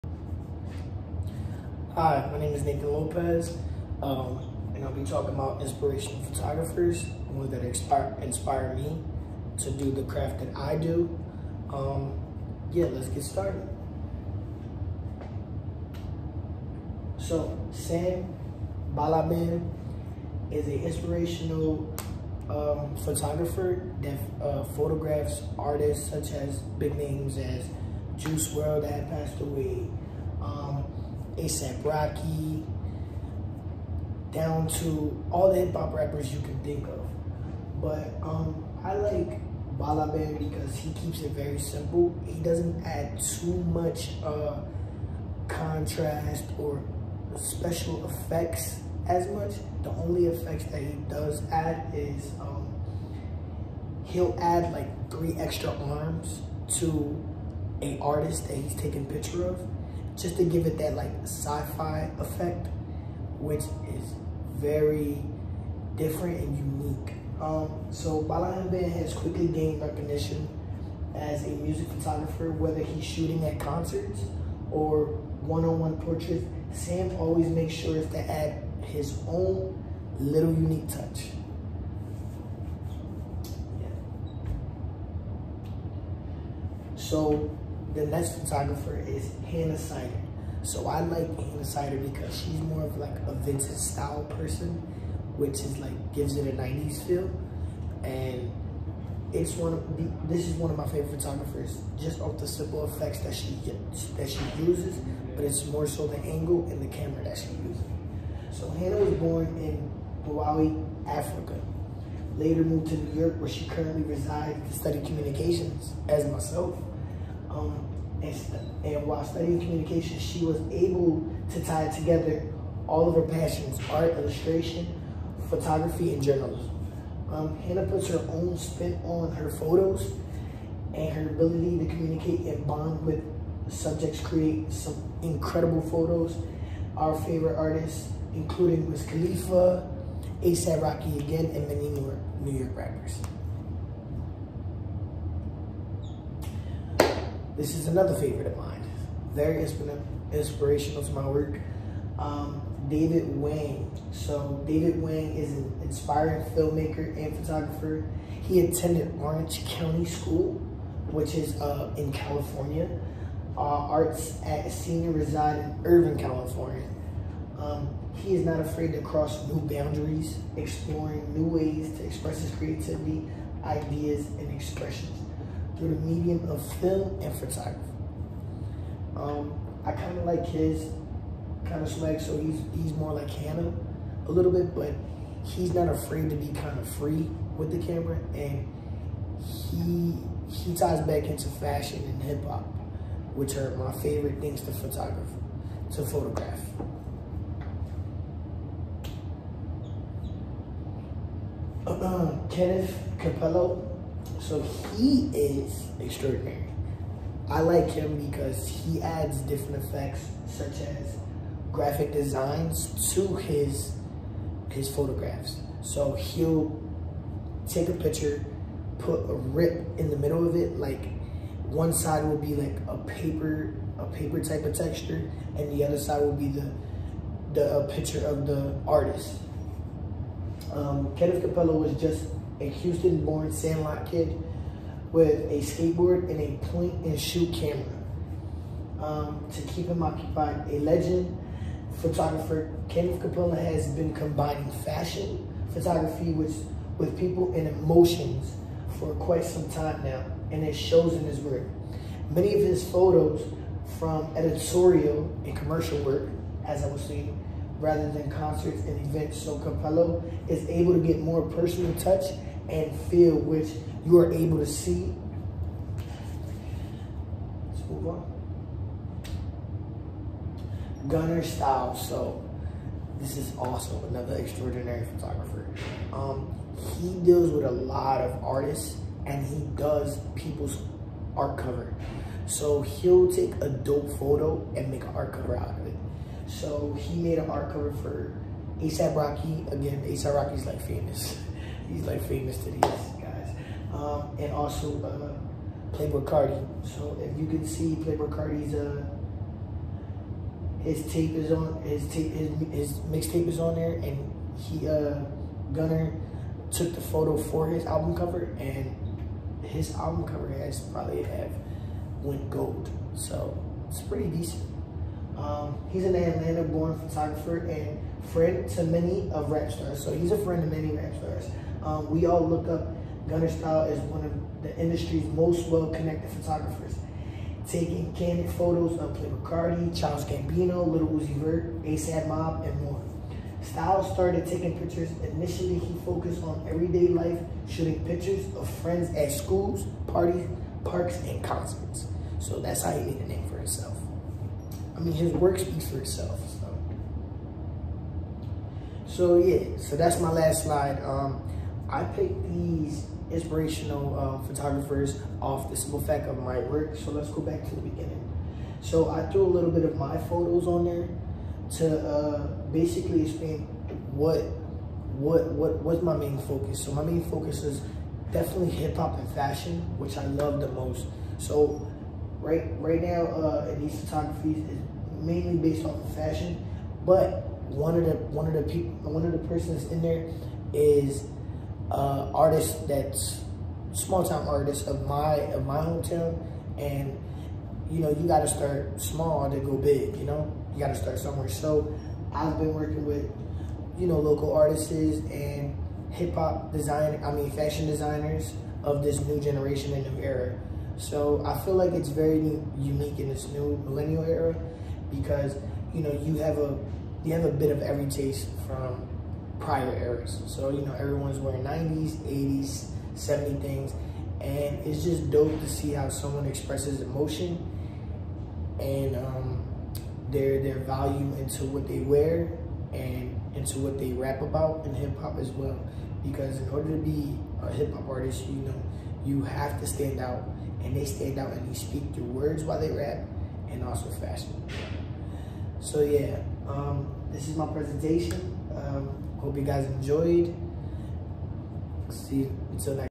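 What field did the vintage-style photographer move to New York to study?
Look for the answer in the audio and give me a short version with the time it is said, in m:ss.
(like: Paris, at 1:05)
communications, at 1:55.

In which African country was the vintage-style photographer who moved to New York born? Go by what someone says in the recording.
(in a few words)
Malawi.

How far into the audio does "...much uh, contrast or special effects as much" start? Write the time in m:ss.
0:43.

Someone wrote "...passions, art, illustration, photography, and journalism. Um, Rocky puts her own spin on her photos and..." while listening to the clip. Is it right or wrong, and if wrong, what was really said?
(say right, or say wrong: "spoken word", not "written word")
wrong: "Hannah", not "Rocky".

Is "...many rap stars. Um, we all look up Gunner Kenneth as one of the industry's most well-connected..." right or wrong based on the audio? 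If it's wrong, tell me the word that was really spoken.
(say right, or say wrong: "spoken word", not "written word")
wrong: "Stahl", not "Kenneth".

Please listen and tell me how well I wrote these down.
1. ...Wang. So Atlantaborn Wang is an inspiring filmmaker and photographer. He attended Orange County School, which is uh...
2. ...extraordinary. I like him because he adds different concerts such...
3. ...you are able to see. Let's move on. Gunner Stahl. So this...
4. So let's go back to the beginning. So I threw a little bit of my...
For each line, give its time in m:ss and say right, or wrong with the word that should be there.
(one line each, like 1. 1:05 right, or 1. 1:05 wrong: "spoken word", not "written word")
1. 2:33 wrong: "David", not "Atlantaborn"
2. 3:25 wrong: "effects", not "concerts"
3. 4:24 right
4. 5:56 right.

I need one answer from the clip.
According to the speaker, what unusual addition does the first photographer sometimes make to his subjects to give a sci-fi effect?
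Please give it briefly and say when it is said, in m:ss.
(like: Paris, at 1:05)
three extra arms, at 0:55.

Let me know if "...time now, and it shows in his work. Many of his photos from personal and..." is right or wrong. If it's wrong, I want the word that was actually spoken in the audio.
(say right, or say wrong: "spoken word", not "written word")
wrong: "editorial", not "personal".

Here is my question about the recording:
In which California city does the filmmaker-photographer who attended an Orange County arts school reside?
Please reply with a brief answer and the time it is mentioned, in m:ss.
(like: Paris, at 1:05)
Irvine, at 2:45.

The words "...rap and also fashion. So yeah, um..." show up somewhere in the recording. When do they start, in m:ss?
7:12.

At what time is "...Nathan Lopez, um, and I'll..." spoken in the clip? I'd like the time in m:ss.
0:02.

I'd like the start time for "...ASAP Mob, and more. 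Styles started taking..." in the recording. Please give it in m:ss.
5:31.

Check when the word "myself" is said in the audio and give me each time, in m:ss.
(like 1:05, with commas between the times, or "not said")
1:56.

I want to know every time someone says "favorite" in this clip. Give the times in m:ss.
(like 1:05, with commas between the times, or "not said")
1:40, 2:17, 2:28, 3:14.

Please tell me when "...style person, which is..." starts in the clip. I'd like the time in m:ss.
1:33.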